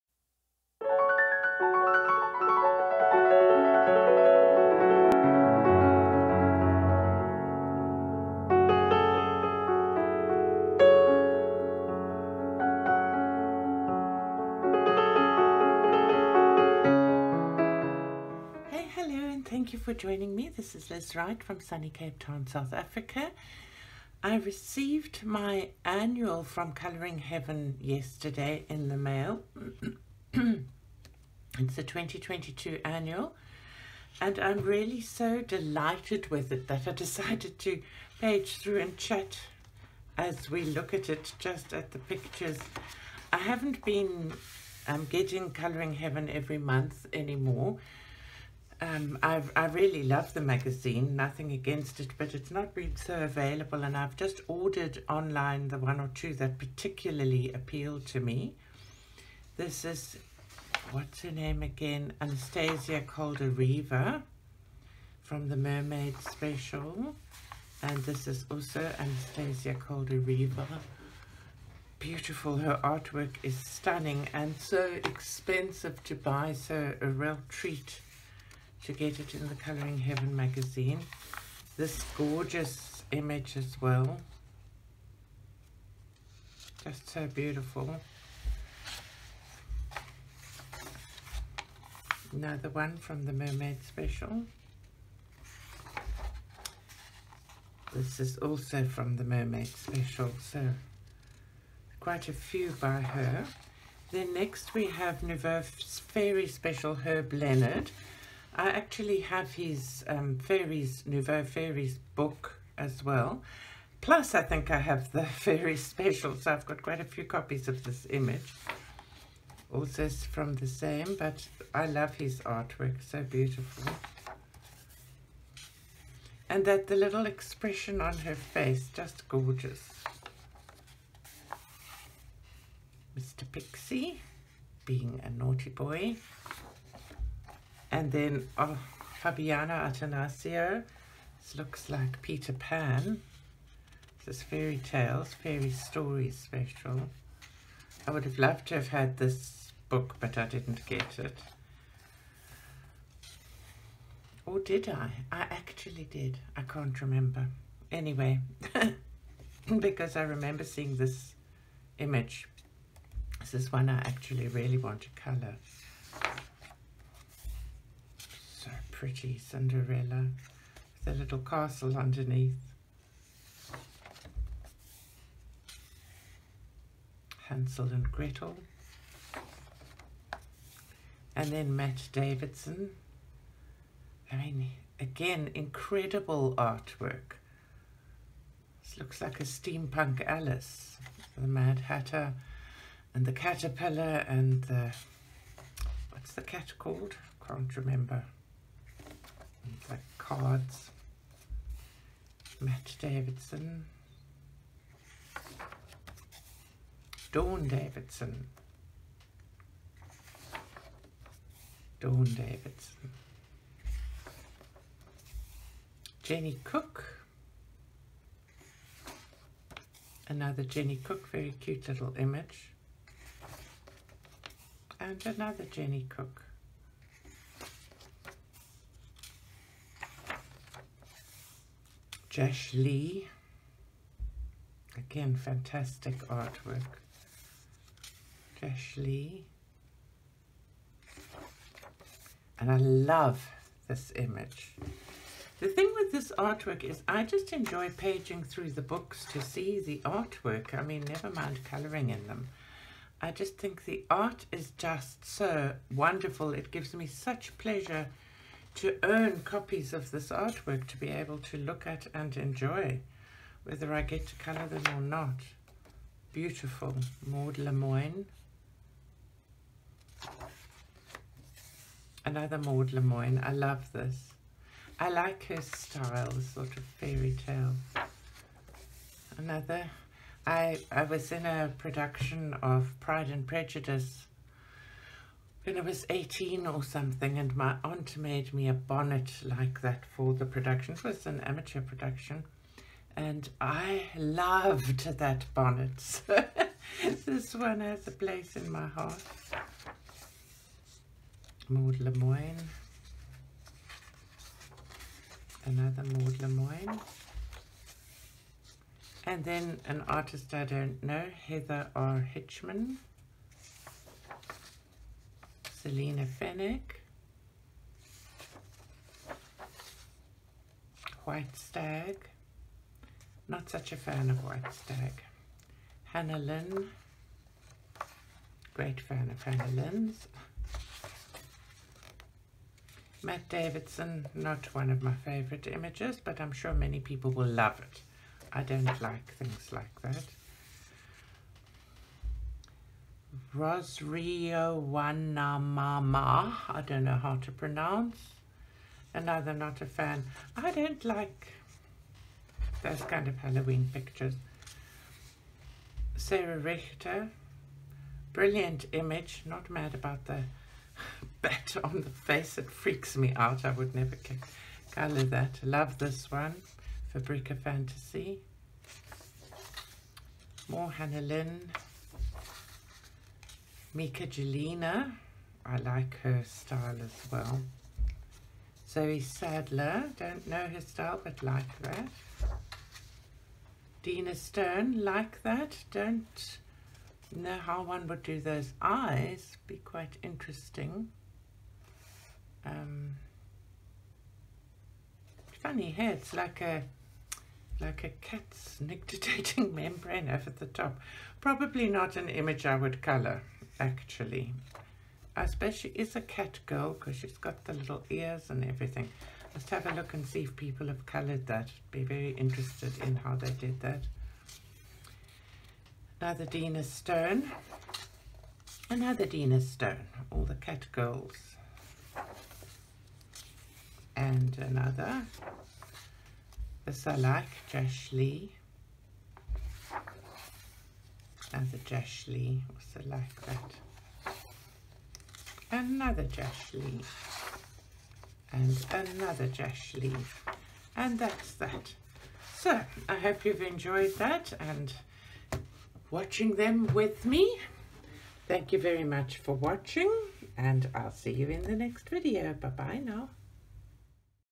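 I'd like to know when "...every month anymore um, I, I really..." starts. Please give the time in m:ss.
0:46.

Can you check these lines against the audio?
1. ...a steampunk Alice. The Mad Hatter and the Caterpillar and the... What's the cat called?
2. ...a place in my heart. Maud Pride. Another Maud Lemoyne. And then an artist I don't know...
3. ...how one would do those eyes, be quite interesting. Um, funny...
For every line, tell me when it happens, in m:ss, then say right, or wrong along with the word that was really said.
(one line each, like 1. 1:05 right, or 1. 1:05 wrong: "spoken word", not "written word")
1. 3:09 right
2. 4:58 wrong: "Lemoyne", not "Pride"
3. 6:27 right.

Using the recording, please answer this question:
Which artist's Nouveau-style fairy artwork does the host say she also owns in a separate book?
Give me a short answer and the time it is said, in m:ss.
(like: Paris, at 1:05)
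Herb Leonard, at 1:46.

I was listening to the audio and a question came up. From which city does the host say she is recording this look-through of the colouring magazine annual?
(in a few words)
Cape Town.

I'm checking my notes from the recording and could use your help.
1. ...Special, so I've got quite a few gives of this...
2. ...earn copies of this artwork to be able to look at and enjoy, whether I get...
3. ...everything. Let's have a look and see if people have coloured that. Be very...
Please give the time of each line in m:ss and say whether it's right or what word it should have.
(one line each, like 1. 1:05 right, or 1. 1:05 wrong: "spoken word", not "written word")
1. 1:55 wrong: "copies", not "gives"
2. 4:19 right
3. 6:48 right.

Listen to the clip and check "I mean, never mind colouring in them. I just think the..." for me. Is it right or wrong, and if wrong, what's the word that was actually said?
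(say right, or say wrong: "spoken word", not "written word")
right.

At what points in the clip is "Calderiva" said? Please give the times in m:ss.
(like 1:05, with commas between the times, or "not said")
1:03, 1:09.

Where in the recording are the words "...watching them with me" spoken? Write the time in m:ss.
7:26.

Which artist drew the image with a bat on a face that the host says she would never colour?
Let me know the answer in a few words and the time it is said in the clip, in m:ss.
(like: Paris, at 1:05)
Sarah Richter, at 5:56.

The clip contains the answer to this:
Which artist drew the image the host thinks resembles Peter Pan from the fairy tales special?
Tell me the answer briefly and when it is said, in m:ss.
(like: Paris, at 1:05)
Fabiana Attanasio, at 2:19.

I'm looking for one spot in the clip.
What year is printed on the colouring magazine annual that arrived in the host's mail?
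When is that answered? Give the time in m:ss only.
0:31.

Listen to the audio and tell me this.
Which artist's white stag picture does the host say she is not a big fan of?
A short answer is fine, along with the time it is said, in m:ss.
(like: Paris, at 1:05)
Selina Fenech, at 5:15.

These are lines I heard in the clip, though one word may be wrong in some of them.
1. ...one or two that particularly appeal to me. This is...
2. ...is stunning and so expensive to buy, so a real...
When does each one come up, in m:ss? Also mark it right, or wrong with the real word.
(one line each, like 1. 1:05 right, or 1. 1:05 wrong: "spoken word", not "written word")
1. 0:55 right
2. 1:13 right.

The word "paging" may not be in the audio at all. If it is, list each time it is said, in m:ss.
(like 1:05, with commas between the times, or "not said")
4:07.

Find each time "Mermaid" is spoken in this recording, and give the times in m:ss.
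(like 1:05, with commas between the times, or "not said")
1:05, 1:33, 1:39.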